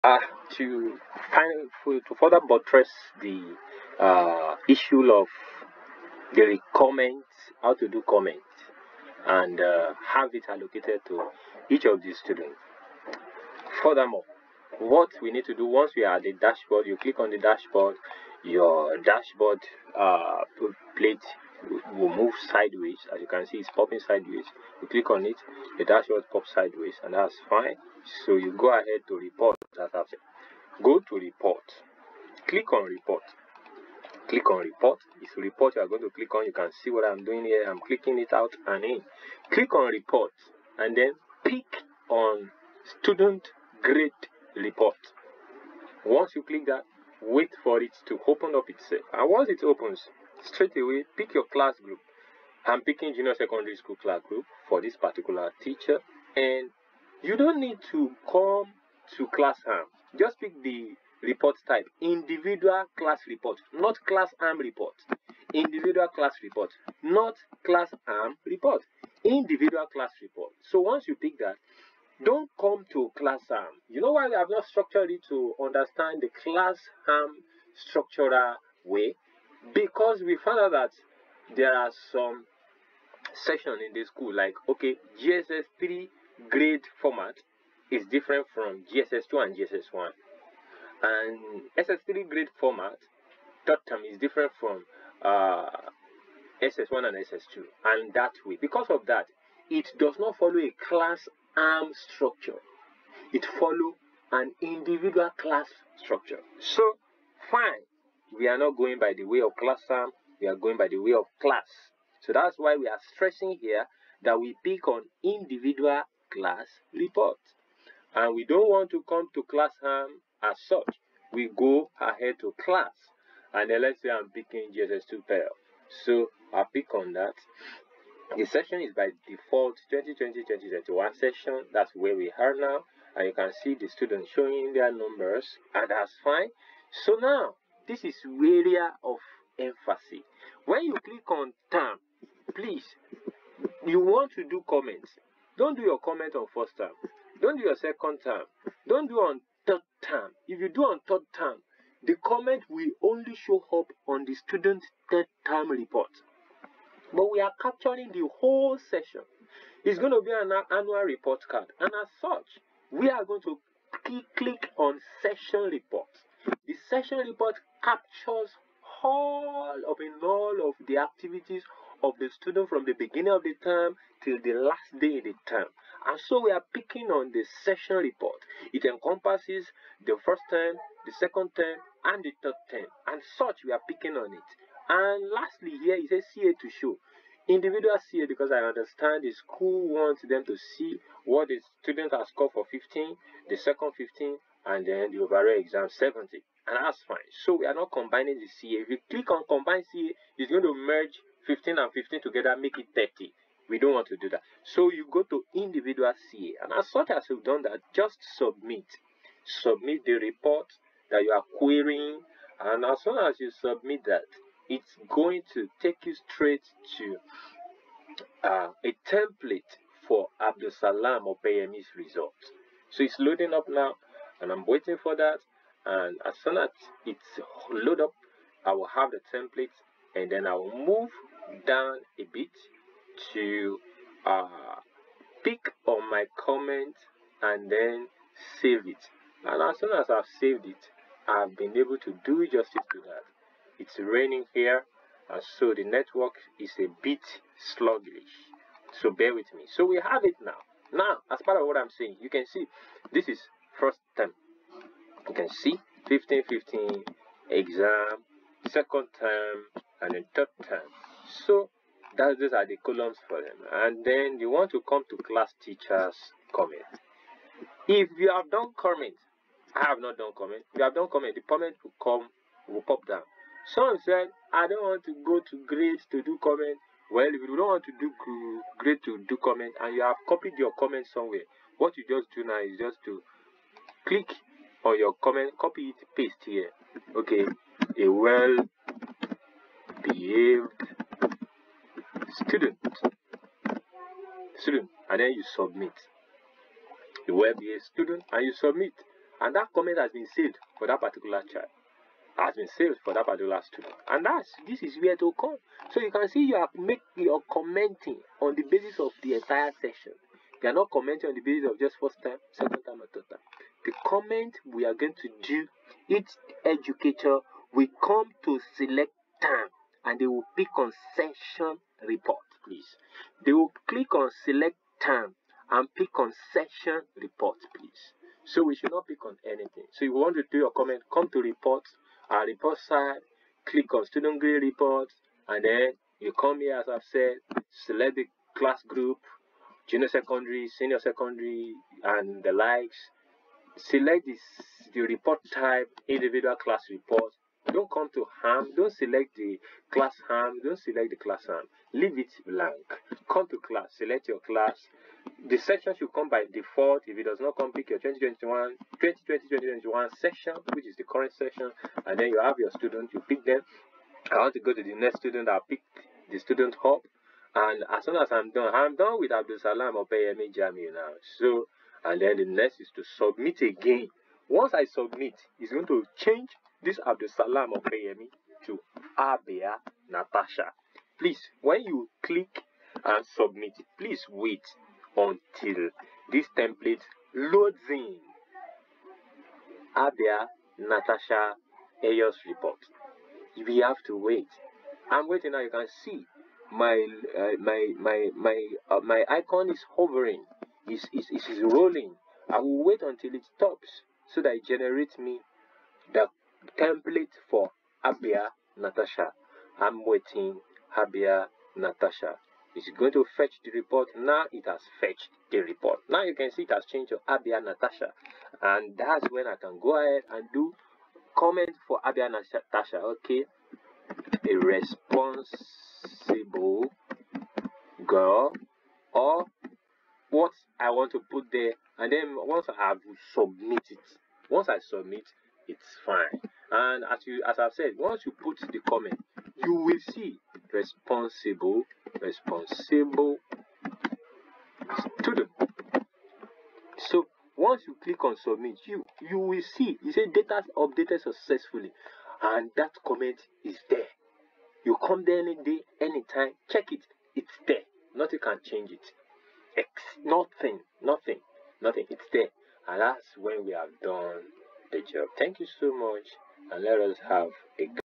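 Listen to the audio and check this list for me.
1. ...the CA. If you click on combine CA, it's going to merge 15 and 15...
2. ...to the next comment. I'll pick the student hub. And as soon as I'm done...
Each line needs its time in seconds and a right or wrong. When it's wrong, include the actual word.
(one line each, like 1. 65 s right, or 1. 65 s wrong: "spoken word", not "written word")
1. 198 s right
2. 364 s wrong: "student", not "comment".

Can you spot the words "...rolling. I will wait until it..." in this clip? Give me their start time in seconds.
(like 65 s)
401 s.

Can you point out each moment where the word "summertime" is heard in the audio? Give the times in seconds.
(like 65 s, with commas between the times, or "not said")
not said.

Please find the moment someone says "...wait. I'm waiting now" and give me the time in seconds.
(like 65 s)
394 s.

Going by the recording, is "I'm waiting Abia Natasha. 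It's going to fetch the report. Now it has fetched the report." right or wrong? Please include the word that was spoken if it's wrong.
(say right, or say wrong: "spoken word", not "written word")
right.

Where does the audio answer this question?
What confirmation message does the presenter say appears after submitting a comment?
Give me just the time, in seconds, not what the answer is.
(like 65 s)
450 s.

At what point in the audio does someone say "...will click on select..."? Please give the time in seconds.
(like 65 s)
323 s.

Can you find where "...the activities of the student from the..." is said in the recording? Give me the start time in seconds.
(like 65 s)
170 s.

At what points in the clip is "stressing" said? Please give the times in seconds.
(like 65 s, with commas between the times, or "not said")
113 s.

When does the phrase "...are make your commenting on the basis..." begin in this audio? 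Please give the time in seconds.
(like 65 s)
306 s.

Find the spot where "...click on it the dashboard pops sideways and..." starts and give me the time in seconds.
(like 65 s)
24 s.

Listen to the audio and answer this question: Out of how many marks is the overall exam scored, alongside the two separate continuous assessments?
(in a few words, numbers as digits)
70.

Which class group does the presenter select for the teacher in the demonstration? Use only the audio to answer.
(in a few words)
Junior secondary school.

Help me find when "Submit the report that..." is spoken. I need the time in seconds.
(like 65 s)
209 s.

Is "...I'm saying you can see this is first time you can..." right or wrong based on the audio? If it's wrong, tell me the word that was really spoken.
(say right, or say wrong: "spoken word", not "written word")
right.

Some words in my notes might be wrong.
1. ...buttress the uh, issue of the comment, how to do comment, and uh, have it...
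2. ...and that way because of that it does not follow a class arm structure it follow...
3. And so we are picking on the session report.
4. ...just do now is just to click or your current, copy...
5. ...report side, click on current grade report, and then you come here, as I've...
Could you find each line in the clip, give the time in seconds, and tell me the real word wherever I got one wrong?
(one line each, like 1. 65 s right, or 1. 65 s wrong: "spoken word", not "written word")
1. 2 s right
2. 97 s right
3. 176 s right
4. 282 s wrong: "comment", not "current"
5. 332 s wrong: "student", not "current".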